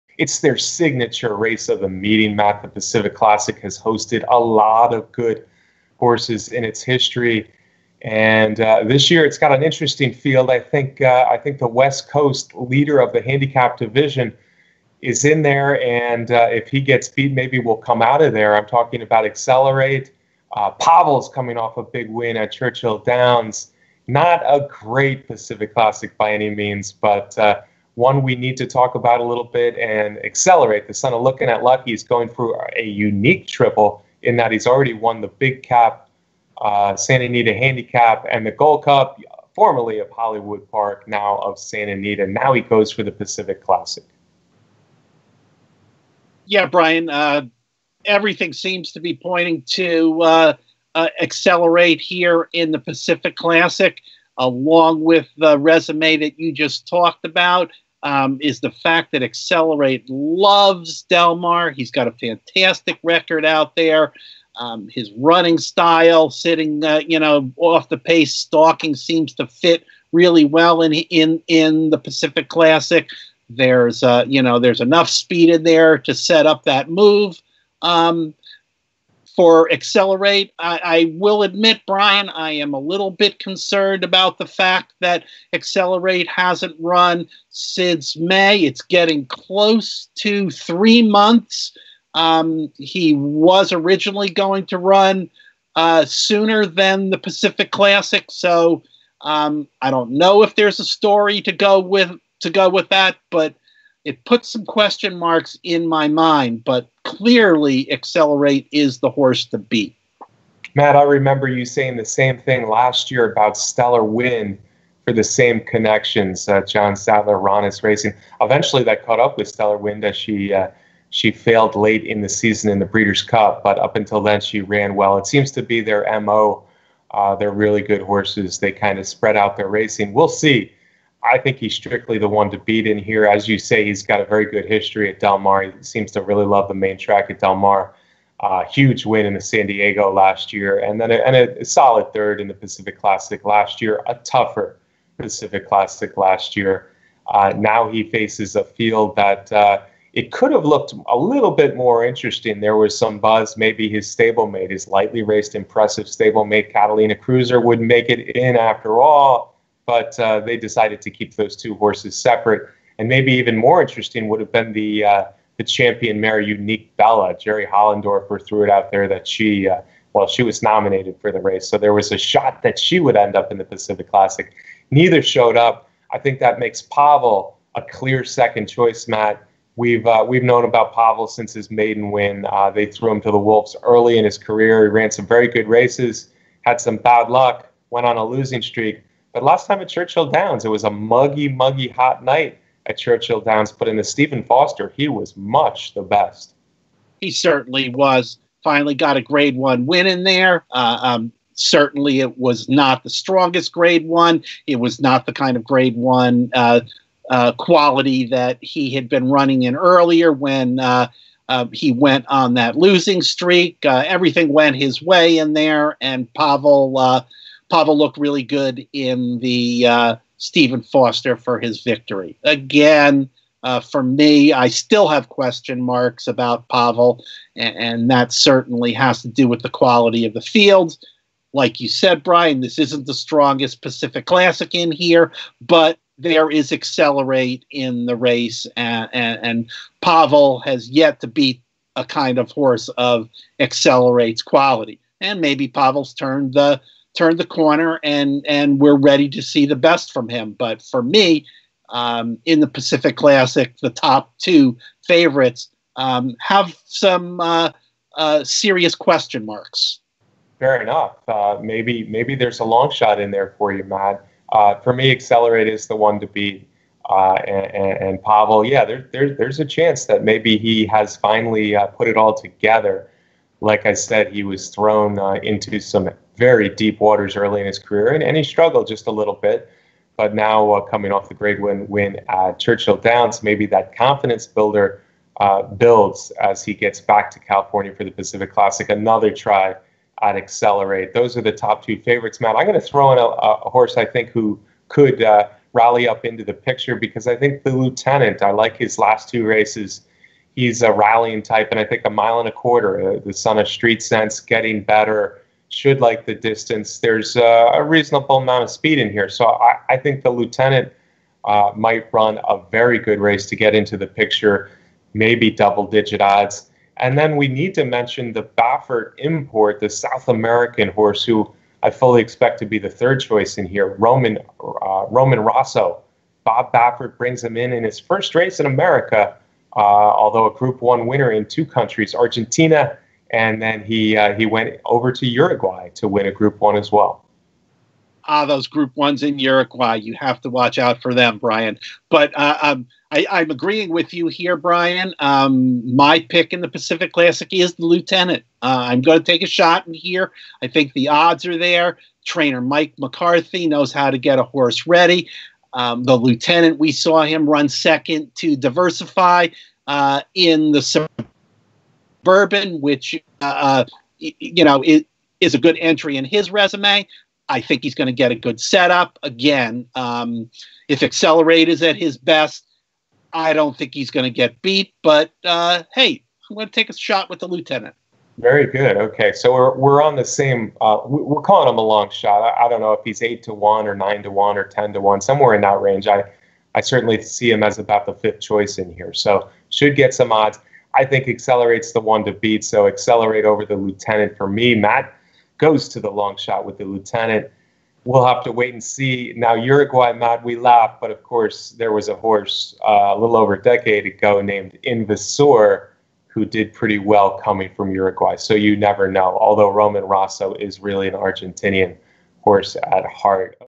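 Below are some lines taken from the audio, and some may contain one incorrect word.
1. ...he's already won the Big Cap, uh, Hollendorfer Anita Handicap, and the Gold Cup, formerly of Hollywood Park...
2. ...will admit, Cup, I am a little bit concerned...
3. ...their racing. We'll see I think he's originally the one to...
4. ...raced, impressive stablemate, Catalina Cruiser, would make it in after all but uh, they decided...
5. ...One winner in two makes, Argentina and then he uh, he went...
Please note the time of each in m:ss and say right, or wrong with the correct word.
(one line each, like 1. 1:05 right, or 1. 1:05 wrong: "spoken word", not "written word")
1. 0:34 wrong: "Santa", not "Hollendorfer"
2. 1:21 wrong: "Brian", not "Cup"
3. 2:09 wrong: "strictly", not "originally"
4. 2:35 right
5. 5:30 wrong: "countries", not "makes".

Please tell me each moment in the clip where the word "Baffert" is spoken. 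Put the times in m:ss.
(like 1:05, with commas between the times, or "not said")
5:18, 5:26.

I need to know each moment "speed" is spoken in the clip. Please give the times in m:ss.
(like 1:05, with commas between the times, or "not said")
1:15, 5:08.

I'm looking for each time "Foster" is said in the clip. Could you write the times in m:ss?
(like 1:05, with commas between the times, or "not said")
3:14, 3:40.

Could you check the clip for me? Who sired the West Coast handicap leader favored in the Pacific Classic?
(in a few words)
Lookin At Lucky.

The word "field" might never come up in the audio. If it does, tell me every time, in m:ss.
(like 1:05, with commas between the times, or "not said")
0:10, 2:28, 3:50.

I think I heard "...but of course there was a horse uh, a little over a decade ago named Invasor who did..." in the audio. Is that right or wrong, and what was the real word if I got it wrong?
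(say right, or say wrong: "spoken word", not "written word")
right.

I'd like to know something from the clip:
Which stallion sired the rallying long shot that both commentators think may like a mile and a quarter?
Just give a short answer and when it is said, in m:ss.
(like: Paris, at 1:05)
Street Sense, at 5:03.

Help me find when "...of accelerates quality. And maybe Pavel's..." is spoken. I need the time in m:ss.
4:02.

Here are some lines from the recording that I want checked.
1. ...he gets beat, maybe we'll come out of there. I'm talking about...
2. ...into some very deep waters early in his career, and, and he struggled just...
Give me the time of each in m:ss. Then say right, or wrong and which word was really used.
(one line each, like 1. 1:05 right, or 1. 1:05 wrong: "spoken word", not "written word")
1. 0:16 right
2. 4:35 right.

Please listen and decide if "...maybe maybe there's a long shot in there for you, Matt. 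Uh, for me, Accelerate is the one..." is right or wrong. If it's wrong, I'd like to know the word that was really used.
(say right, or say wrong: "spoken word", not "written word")
right.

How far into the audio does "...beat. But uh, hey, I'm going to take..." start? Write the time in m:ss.
6:14.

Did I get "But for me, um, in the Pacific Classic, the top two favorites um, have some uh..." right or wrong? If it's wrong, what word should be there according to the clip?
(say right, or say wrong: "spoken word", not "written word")
right.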